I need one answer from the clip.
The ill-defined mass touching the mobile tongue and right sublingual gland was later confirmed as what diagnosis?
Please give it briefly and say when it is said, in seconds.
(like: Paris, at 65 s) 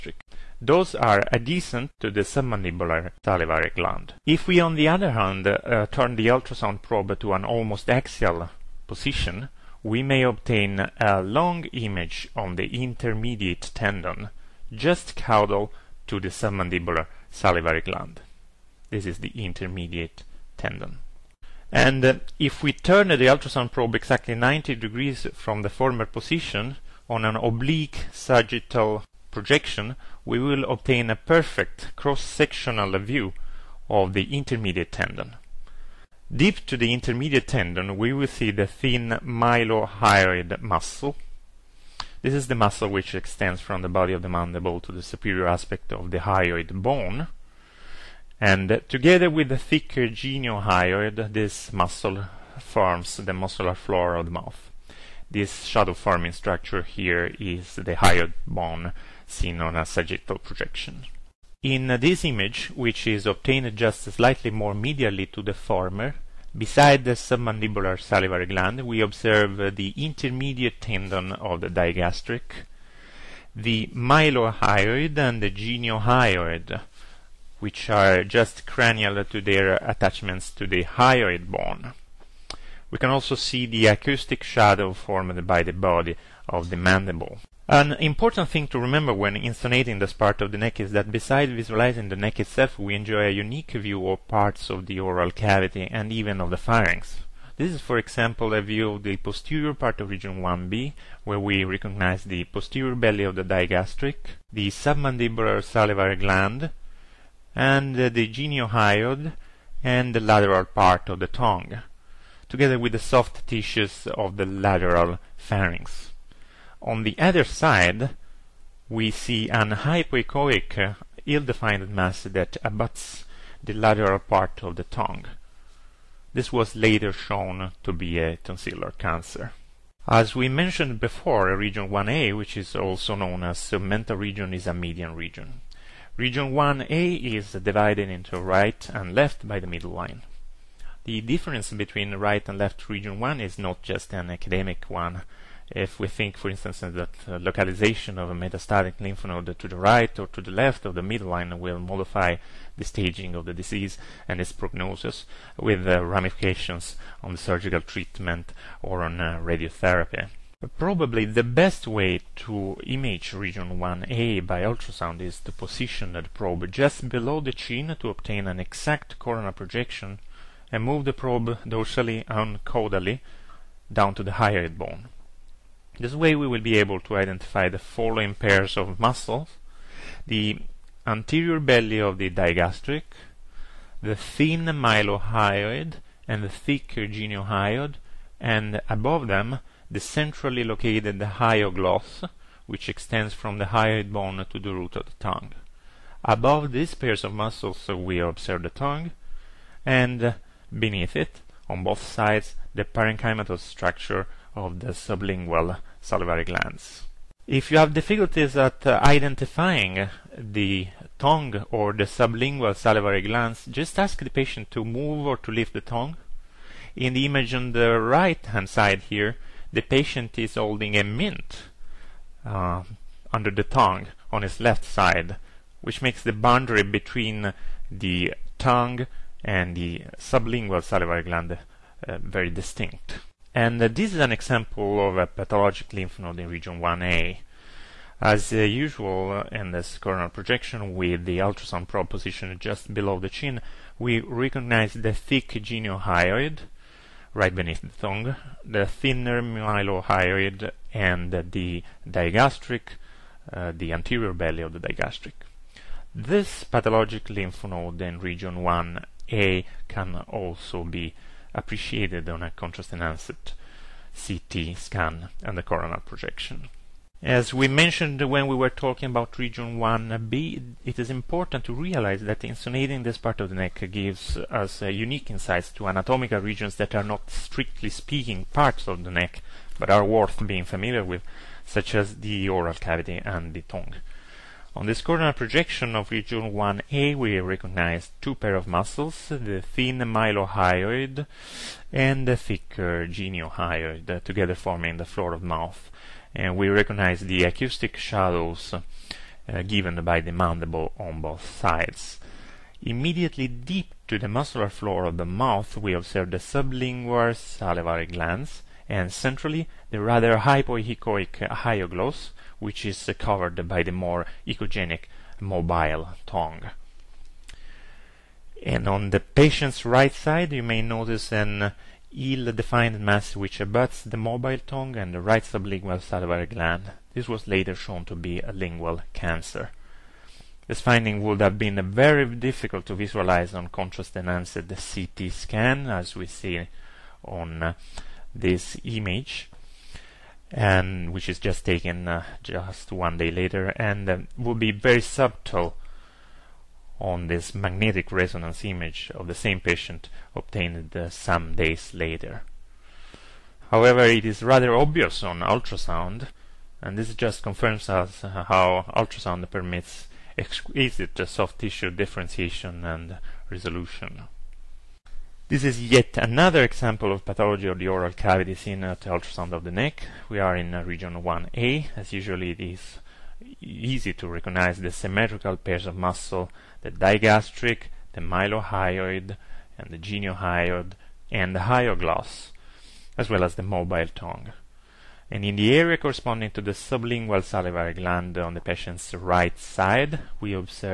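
lingual cancer, at 328 s.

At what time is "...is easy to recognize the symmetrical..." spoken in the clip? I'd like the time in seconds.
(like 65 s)
372 s.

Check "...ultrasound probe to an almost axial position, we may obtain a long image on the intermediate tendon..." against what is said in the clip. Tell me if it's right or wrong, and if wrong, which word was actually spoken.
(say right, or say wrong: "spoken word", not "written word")
right.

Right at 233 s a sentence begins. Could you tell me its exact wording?
And uh, this is an example of a pathologic lymph node in region 1A.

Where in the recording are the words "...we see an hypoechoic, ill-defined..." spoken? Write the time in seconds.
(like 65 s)
118 s.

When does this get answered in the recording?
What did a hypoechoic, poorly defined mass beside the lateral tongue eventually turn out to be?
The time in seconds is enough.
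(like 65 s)
128 s.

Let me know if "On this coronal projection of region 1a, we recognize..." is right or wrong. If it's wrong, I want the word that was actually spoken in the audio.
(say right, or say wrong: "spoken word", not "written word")
right.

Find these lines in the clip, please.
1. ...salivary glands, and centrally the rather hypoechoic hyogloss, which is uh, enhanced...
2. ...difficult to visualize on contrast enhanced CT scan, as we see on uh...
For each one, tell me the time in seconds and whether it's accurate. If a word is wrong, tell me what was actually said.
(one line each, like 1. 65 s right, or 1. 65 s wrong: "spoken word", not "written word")
1. 307 s wrong: "covered", not "enhanced"
2. 332 s right.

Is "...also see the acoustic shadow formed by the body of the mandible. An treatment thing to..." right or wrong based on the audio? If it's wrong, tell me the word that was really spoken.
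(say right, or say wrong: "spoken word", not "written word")
wrong: "important", not "treatment".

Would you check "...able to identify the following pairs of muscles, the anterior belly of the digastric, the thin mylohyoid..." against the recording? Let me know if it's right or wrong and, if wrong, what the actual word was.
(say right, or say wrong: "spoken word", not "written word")
right.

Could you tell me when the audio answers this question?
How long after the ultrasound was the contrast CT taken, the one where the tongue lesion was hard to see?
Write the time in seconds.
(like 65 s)
342 s.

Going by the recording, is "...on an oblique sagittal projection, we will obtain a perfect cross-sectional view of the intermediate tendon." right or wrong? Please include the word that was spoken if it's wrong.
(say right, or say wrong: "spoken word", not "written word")
right.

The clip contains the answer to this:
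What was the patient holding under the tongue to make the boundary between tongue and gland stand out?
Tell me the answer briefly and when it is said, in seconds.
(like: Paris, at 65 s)
a mint, at 220 s.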